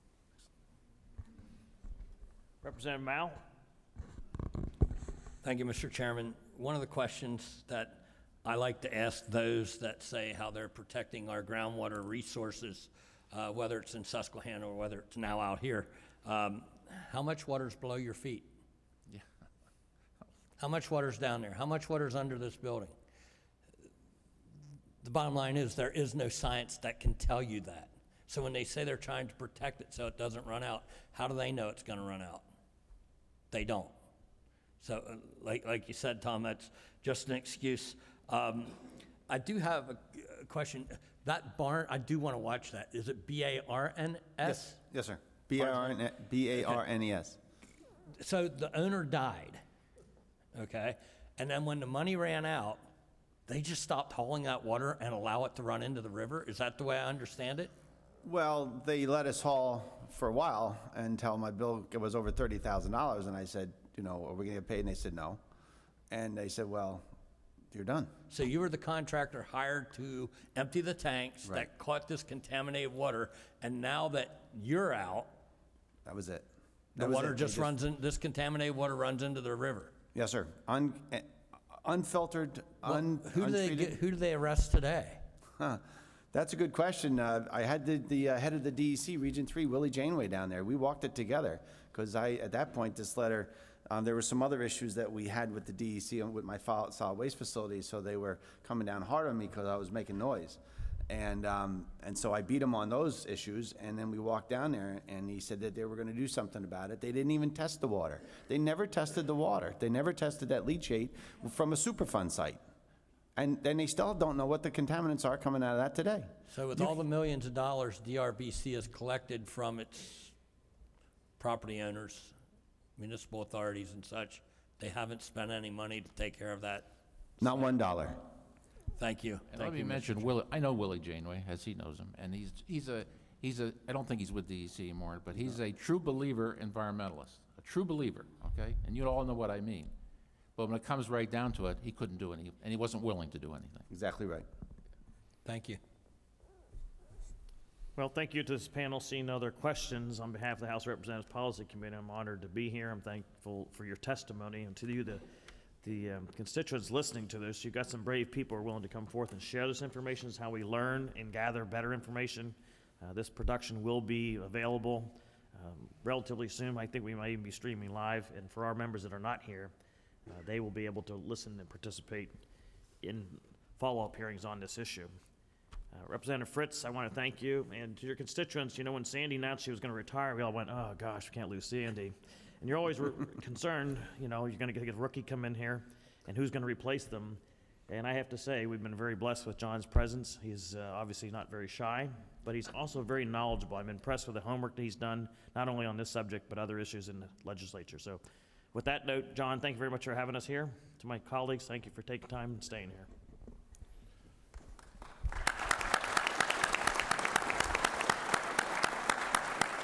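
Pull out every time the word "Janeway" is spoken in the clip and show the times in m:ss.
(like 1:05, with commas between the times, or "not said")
1:29, 2:11.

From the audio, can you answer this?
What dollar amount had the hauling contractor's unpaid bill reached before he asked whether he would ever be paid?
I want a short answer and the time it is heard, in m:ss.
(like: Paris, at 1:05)
$30,000, at 1:02.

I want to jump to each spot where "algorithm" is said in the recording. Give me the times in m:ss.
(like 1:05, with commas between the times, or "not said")
not said.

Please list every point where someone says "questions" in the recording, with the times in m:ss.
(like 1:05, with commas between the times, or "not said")
0:06, 0:40, 1:26, 2:29.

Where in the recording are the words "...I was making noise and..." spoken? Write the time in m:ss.
1:39.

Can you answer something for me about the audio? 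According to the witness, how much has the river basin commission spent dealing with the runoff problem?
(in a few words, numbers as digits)
Not one dollar.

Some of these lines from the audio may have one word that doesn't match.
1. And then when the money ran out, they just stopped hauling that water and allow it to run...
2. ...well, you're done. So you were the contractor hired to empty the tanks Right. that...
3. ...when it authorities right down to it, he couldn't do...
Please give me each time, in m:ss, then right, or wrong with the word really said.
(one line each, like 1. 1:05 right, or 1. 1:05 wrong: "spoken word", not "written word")
1. 0:51 right
2. 1:06 right
3. 2:20 wrong: "comes", not "authorities".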